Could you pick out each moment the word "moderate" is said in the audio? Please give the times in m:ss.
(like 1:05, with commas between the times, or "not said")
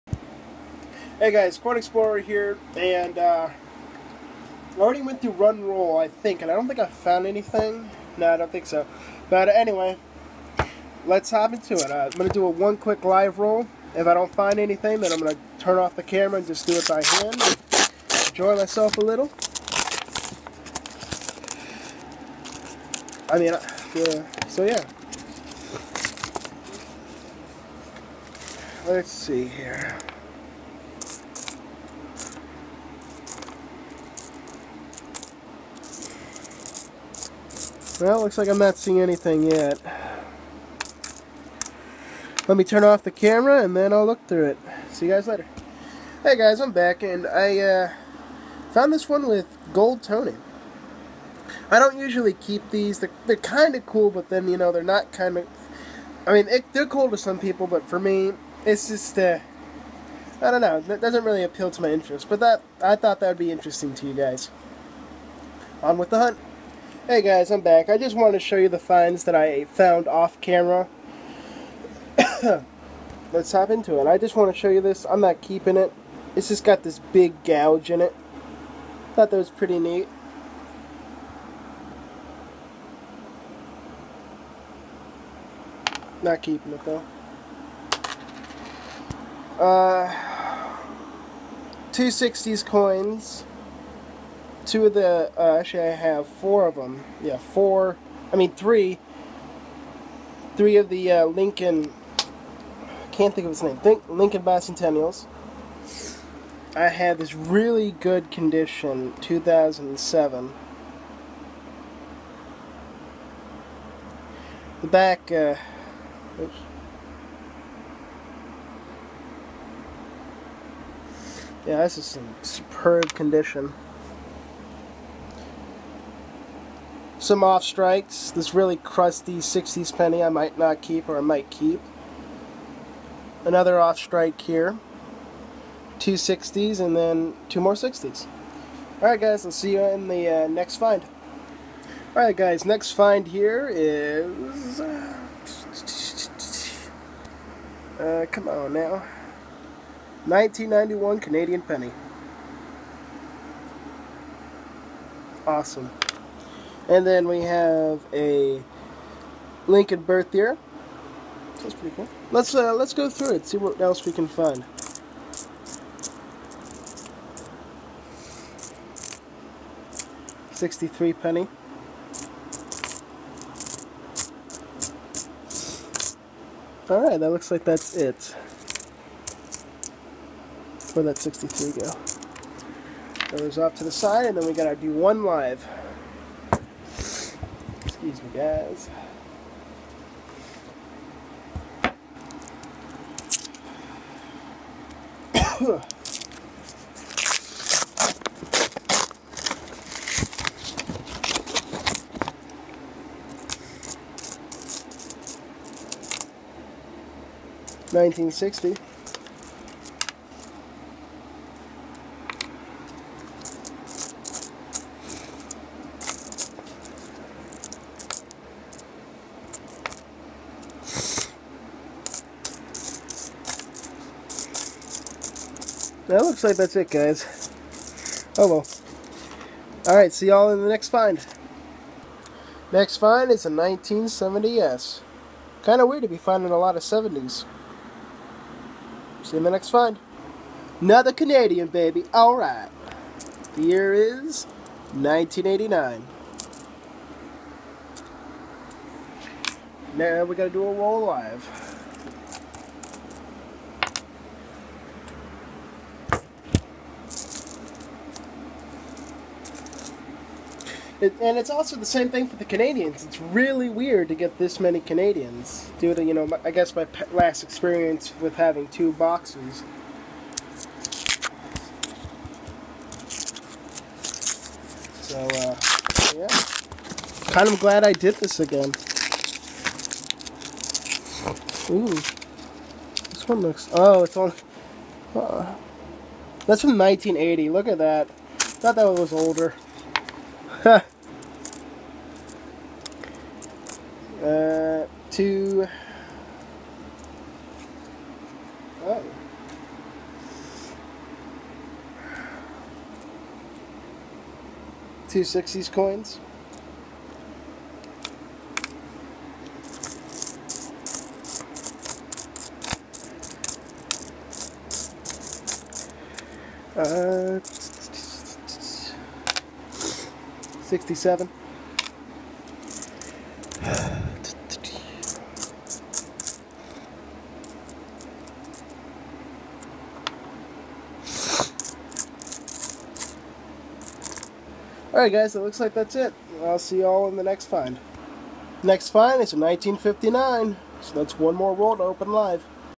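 not said.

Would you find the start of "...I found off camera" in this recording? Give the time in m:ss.
1:09.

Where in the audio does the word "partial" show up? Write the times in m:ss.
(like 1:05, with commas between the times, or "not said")
not said.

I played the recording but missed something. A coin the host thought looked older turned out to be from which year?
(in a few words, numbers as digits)
1980.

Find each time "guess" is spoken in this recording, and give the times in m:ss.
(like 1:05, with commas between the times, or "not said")
4:26.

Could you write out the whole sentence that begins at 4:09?
Now we gotta do a roll live.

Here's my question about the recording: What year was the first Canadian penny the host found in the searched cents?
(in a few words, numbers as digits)
1991.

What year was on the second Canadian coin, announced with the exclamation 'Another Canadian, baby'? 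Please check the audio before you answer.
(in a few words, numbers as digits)
1989.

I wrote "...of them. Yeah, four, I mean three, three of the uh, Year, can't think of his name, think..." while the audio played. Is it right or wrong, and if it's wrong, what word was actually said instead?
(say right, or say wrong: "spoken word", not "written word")
wrong: "Lincoln", not "Year".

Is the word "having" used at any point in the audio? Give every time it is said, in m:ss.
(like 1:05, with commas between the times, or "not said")
4:28.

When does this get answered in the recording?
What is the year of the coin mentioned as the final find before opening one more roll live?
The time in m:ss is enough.
5:39.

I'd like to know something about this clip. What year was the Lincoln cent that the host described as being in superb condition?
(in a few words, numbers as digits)
2007.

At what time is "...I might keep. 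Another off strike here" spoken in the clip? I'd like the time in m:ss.
2:11.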